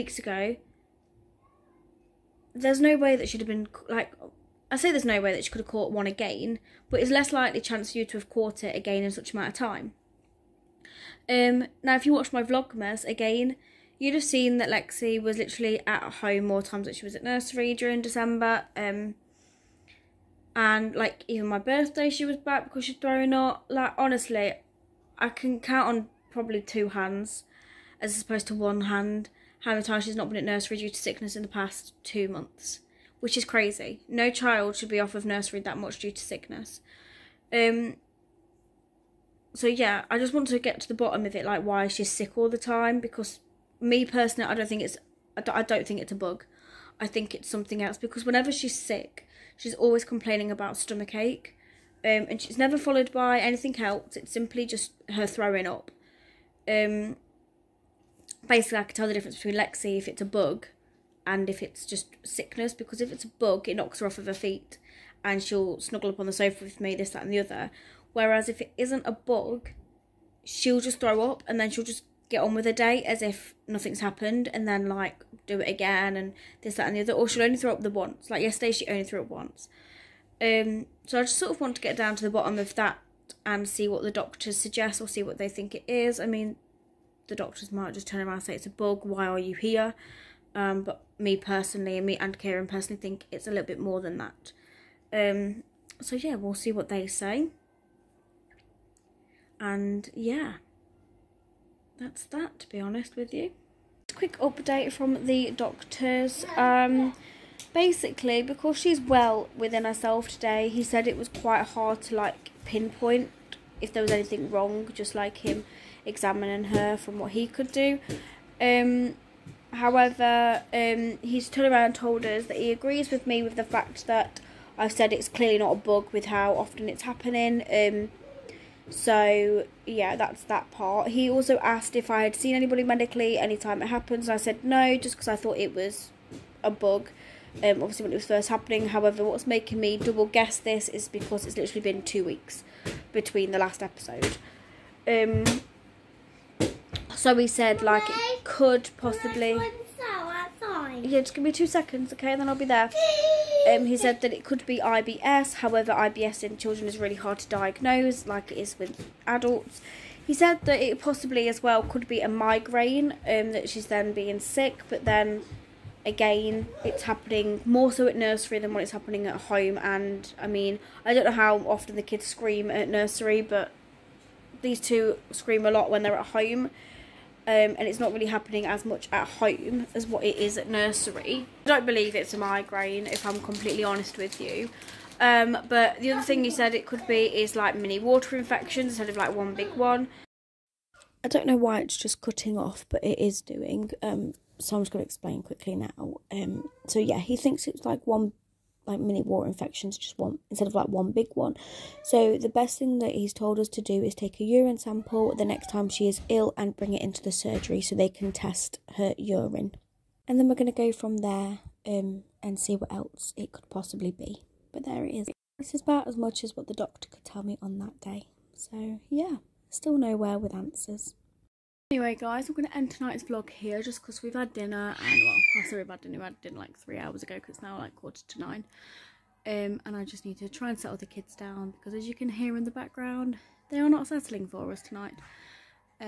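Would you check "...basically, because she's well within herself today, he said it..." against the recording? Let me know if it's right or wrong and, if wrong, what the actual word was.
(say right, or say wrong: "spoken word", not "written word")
right.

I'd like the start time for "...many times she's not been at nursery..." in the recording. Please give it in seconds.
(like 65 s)
29 s.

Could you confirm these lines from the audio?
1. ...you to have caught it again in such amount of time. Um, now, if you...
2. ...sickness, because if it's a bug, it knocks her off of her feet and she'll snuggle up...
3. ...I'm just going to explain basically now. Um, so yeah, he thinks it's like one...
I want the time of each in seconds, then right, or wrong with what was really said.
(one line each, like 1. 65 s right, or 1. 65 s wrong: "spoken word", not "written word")
1. 7 s right
2. 62 s right
3. 194 s wrong: "quickly", not "basically".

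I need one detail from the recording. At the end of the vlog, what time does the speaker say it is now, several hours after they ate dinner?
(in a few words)
quarter to nine.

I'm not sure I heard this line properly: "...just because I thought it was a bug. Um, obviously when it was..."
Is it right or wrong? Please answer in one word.
right.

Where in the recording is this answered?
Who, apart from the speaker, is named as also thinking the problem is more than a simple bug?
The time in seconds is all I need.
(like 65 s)
92 s.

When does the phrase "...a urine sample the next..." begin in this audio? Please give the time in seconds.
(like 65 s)
204 s.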